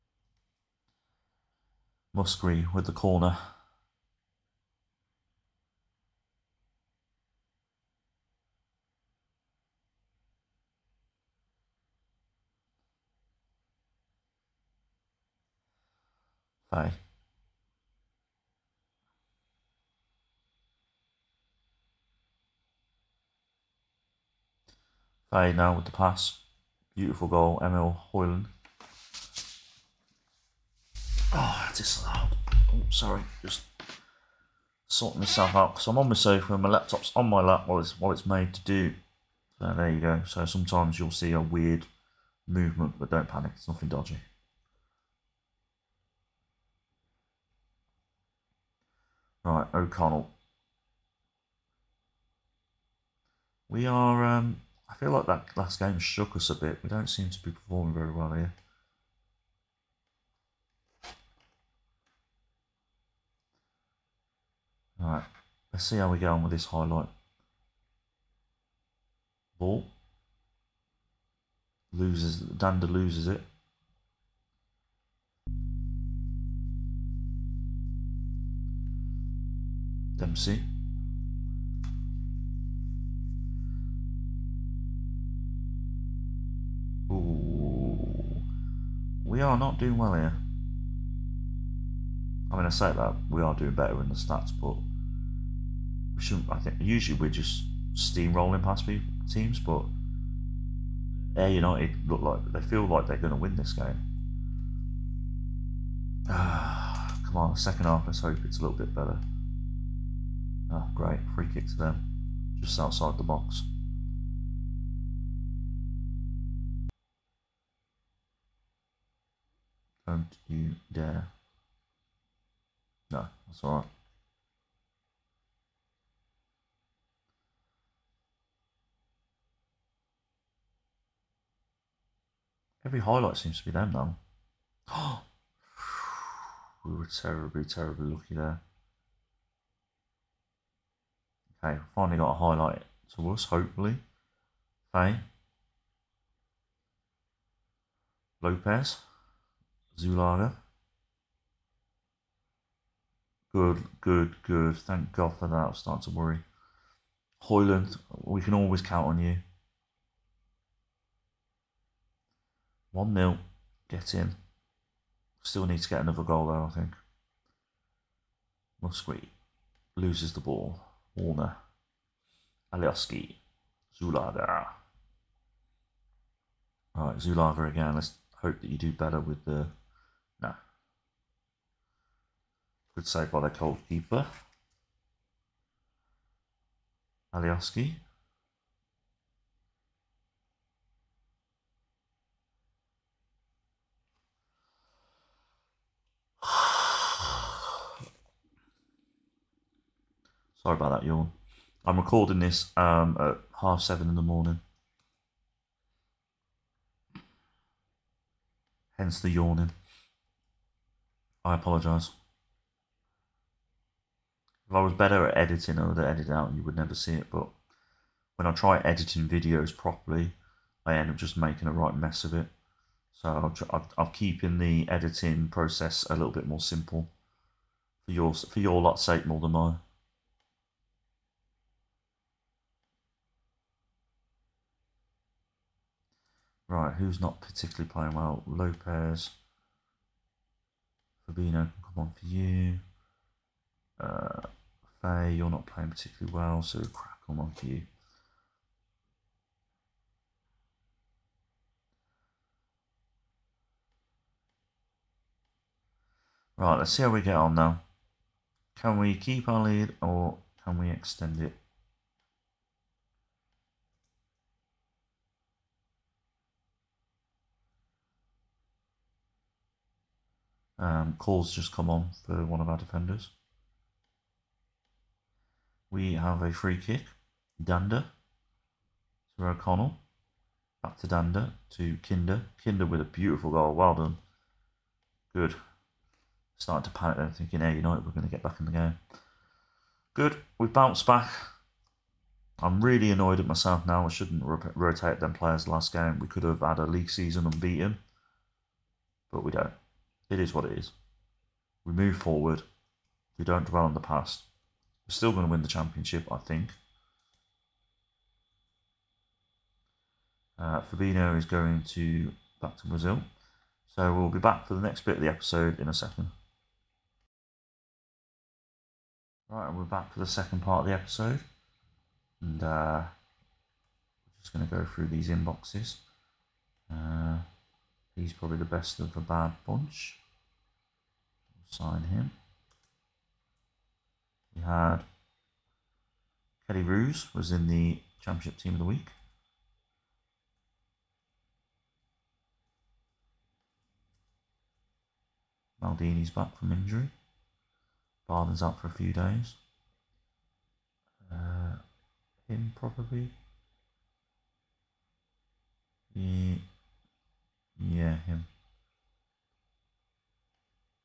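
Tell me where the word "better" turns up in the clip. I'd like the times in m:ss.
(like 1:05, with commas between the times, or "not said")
1:33, 1:48, 2:58, 3:34.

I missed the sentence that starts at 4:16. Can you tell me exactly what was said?
Right, let's see how we get on now.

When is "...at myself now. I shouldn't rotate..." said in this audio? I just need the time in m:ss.
4:53.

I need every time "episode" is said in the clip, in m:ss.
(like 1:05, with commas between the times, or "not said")
5:15, 5:20.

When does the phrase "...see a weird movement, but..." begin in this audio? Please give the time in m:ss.
0:41.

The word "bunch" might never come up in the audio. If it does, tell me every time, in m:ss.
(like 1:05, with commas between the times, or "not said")
5:29.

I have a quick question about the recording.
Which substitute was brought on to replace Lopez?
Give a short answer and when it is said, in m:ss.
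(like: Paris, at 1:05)
Fabinho, at 4:01.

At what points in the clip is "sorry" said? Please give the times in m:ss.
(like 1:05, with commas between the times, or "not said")
0:32, 3:20.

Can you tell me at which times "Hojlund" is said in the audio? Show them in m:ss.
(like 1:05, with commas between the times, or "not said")
0:28, 2:37.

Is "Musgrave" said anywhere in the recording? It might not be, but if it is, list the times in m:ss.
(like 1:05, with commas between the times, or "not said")
0:02, 2:48.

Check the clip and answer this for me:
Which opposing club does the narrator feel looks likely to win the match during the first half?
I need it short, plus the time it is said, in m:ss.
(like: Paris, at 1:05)
Ayr United, at 1:41.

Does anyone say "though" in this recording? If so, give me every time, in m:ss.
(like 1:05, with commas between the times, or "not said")
2:13.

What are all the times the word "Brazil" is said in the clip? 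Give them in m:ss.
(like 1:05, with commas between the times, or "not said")
5:12.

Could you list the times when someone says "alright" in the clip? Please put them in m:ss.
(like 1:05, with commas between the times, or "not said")
1:04, 2:03, 2:56.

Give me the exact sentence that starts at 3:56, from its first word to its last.
Right, who's not particularly playing well?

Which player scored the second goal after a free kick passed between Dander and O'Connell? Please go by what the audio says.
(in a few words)
Kinder.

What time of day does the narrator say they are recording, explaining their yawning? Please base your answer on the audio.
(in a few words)
7:30 in the morning.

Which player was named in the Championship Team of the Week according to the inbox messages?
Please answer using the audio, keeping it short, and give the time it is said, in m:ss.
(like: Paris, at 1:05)
Kelly Ruse, at 5:36.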